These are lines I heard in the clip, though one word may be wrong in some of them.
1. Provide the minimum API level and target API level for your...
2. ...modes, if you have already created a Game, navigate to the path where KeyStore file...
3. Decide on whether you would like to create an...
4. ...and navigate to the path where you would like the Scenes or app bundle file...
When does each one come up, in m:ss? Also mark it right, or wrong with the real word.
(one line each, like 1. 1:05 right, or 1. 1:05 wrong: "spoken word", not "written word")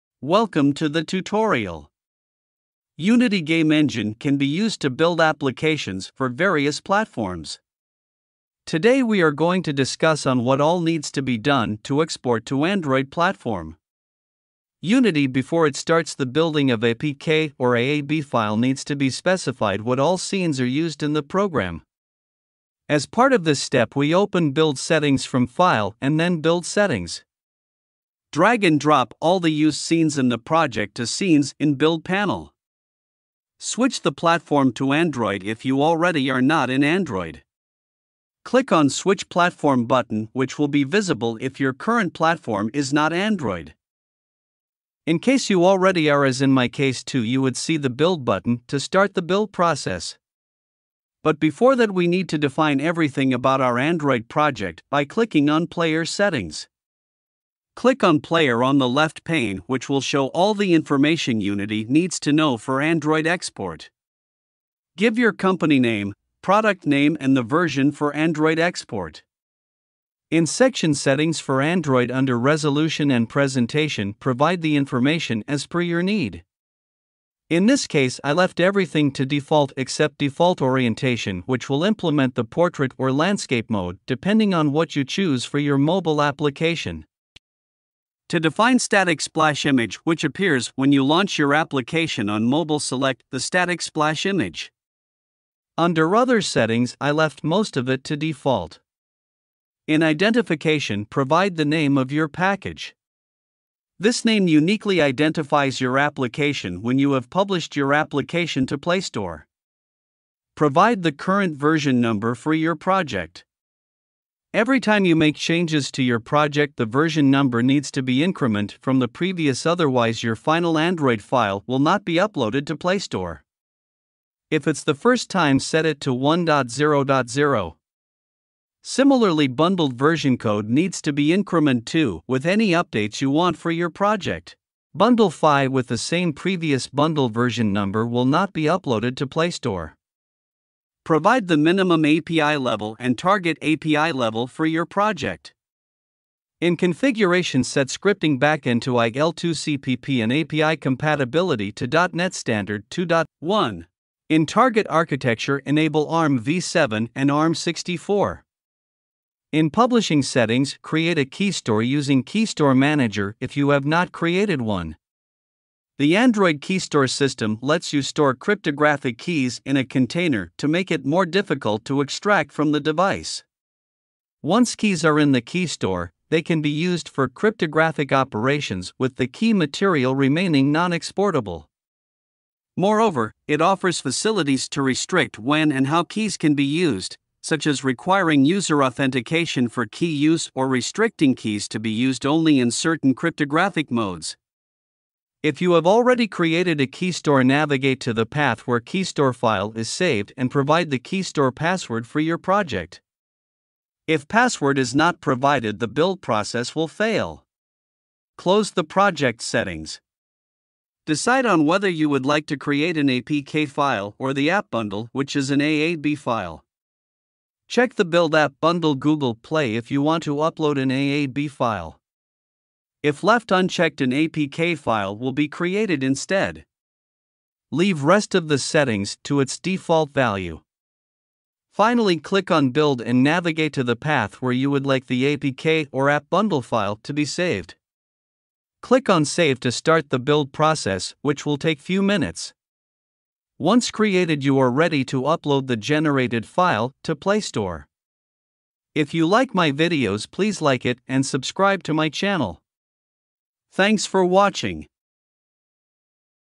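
1. 2:21 right
2. 3:13 wrong: "KeyStore", not "Game"
3. 3:31 right
4. 3:53 wrong: "APK", not "Scenes".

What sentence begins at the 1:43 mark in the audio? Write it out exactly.
This name uniquely identifies your application when you have published your application to Play Store.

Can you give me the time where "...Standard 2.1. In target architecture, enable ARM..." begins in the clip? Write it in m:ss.
2:32.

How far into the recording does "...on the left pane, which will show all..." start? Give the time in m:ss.
0:58.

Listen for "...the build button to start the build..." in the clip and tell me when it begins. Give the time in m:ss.
0:47.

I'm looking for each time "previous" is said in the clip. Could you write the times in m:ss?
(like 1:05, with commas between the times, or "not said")
1:59, 2:16.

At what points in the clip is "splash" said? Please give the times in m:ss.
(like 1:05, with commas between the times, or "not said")
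1:29, 1:33.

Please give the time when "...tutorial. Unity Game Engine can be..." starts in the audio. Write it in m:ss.
0:01.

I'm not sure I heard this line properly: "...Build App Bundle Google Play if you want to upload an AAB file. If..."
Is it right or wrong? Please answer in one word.
right.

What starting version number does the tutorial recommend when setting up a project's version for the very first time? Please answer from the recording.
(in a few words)
1.0.0.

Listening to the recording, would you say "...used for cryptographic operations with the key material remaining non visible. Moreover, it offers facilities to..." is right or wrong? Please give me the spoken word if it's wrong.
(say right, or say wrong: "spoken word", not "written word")
wrong: "exportable", not "visible".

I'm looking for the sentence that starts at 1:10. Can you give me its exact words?
In section Settings for Android under Resolution and Presentation, provide the information as per your need.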